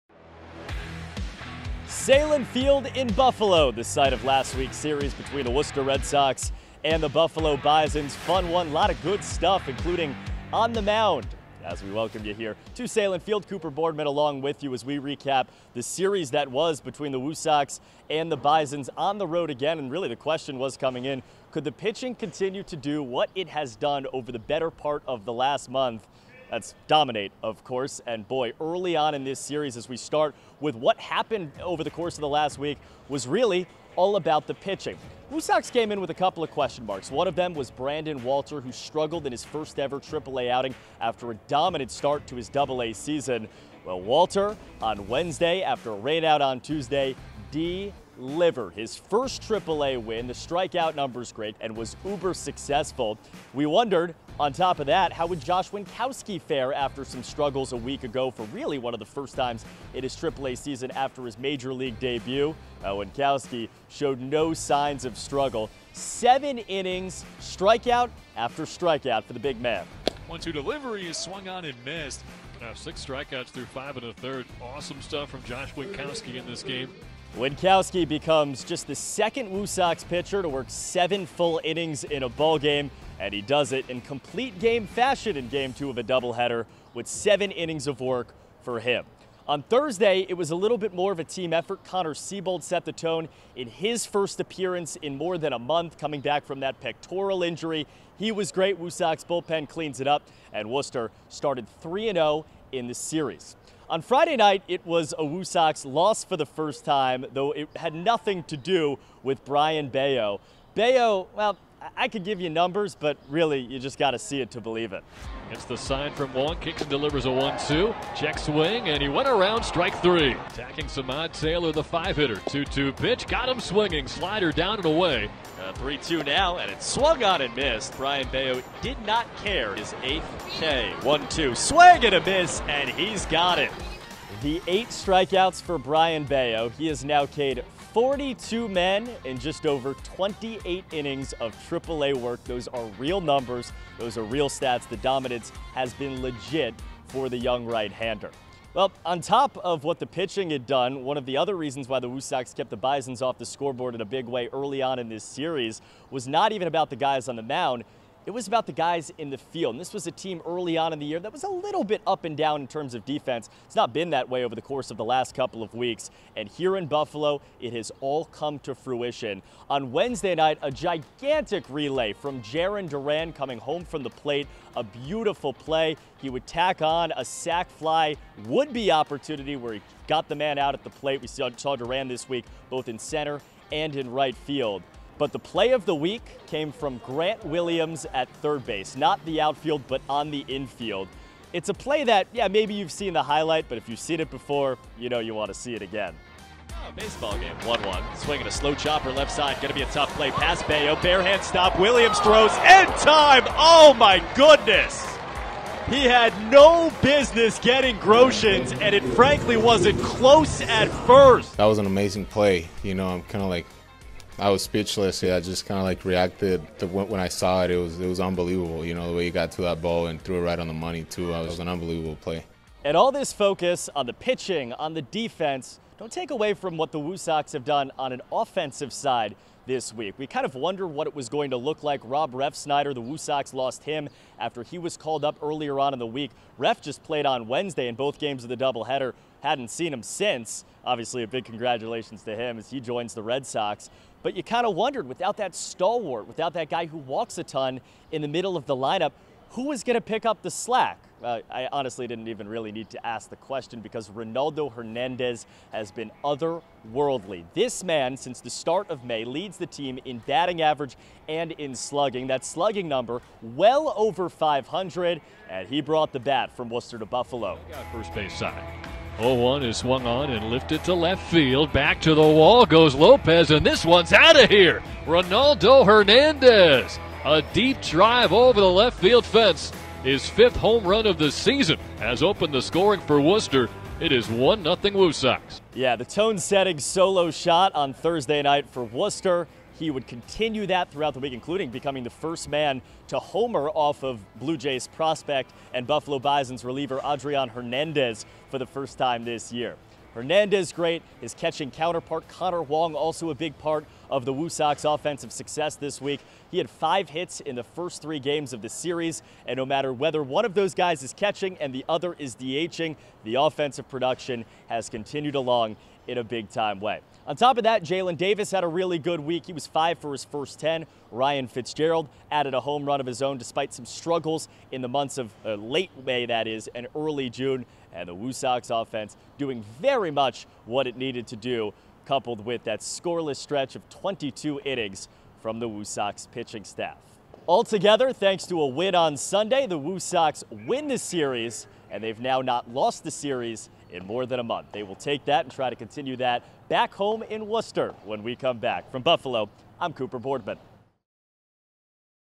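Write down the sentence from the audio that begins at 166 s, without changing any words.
And here in Buffalo, it has all come to fruition.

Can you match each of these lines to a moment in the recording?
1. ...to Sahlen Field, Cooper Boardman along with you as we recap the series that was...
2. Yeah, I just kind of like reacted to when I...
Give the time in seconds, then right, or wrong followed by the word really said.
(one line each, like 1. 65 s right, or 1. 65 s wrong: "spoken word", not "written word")
1. 12 s right
2. 215 s right.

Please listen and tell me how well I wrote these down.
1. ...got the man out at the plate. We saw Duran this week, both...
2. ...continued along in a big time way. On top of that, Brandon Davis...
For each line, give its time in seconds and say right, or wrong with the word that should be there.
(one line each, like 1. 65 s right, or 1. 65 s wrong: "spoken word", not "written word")
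1. 180 s right
2. 314 s wrong: "Jaylin", not "Brandon".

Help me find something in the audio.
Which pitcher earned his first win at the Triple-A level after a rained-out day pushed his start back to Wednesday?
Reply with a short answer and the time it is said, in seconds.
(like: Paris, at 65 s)
Brandon Walter, at 37 s.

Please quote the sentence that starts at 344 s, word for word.
They will take that and try to continue that back home in Worcester when we come back.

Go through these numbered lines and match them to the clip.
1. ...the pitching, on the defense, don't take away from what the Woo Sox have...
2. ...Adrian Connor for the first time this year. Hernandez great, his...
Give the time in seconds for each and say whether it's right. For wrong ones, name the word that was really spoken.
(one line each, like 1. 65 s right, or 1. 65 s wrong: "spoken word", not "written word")
1. 224 s right
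2. 297 s wrong: "Hernandez", not "Connor".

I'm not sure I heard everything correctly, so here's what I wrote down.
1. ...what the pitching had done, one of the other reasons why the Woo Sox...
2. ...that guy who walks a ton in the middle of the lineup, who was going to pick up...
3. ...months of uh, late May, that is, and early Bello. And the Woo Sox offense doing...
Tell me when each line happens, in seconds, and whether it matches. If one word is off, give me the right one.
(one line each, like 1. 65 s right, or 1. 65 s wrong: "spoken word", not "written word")
1. 149 s right
2. 246 s right
3. 324 s wrong: "June", not "Bello".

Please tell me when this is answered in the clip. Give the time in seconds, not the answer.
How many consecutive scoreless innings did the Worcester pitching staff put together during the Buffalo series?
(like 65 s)
333 s.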